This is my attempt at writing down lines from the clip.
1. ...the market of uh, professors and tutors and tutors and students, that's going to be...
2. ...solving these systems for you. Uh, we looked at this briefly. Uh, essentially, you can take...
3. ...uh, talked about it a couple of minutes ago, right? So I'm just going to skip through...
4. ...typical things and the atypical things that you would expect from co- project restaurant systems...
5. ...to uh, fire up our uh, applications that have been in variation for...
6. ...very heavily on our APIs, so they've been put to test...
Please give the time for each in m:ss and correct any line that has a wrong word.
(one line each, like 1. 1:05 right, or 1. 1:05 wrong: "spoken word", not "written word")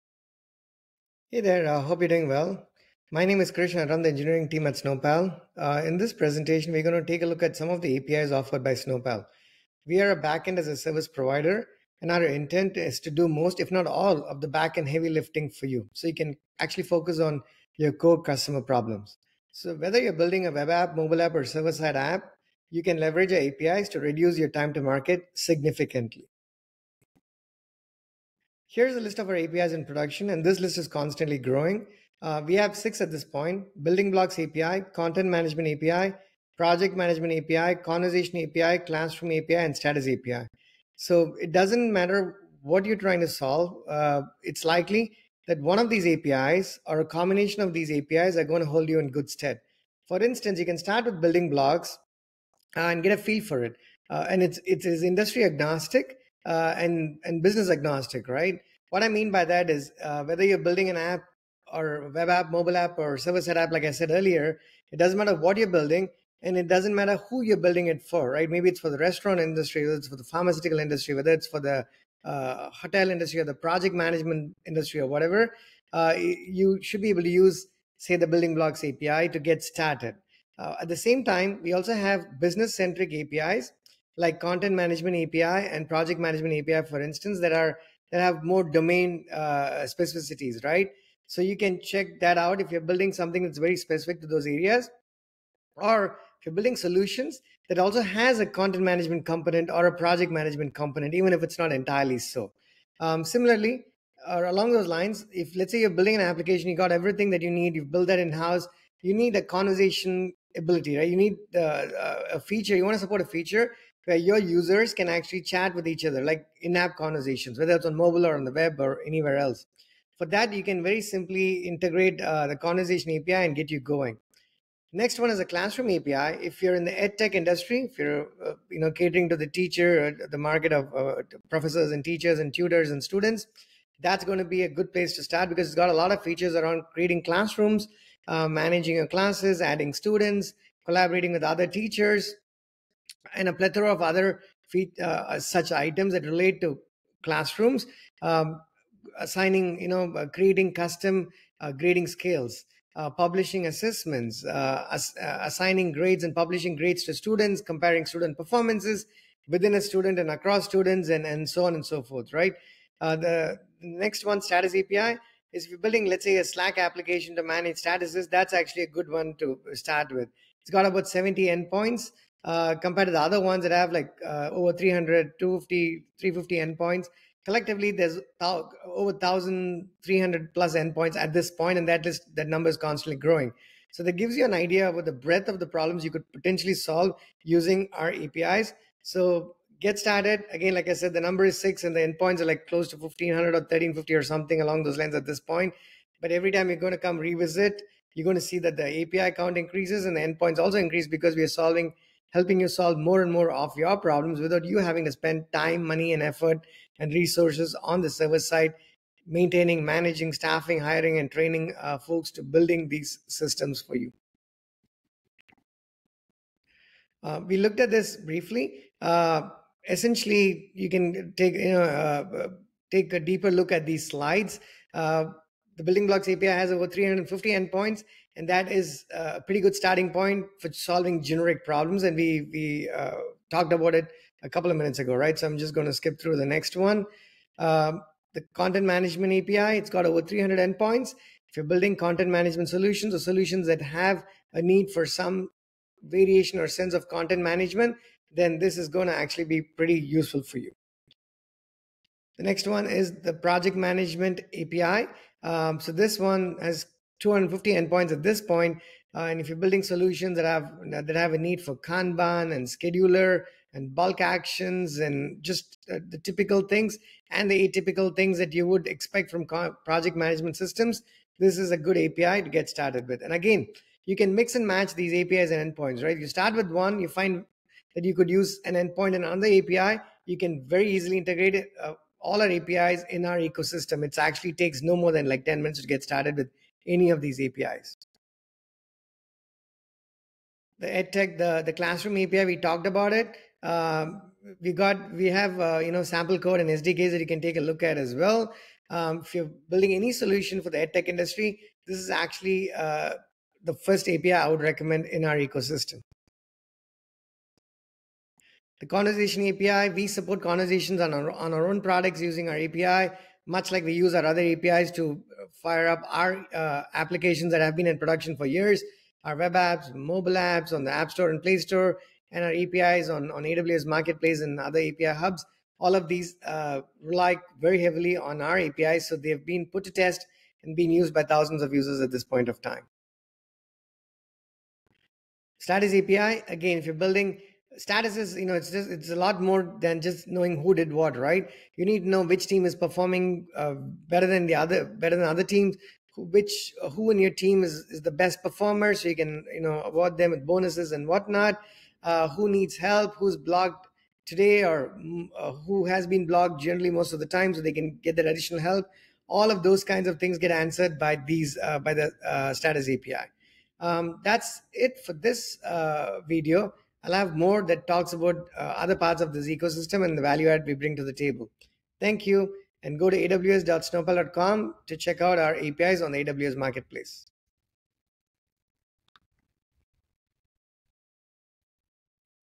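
1. 2:10 wrong: "teachers", not "tutors"
2. 3:32 wrong: "building", not "solving"
3. 3:52 right
4. 4:26 wrong: "management", not "restaurant"
5. 5:14 wrong: "production", not "variation"
6. 5:27 right.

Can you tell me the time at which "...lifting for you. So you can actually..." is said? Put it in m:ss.
0:15.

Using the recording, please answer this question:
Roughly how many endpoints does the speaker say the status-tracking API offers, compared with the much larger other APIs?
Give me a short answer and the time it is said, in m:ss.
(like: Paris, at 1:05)
70, at 2:51.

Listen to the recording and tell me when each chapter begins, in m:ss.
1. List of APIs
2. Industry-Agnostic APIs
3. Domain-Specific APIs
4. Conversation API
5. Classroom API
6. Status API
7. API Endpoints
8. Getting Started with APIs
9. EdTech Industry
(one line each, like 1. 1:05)
1. 0:28
2. 1:24
3. 1:53
4. 2:23
5. 2:52
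6. 3:22
7. 3:37
8. 4:50
9. 5:08.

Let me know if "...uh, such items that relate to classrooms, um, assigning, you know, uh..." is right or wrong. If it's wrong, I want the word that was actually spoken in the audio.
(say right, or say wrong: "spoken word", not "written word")
right.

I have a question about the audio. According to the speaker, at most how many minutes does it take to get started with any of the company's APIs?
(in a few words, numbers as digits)
10.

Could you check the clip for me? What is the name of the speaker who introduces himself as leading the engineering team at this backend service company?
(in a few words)
Krishna.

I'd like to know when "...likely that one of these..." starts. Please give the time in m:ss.
0:44.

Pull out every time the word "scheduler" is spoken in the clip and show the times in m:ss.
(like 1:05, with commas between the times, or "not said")
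4:22.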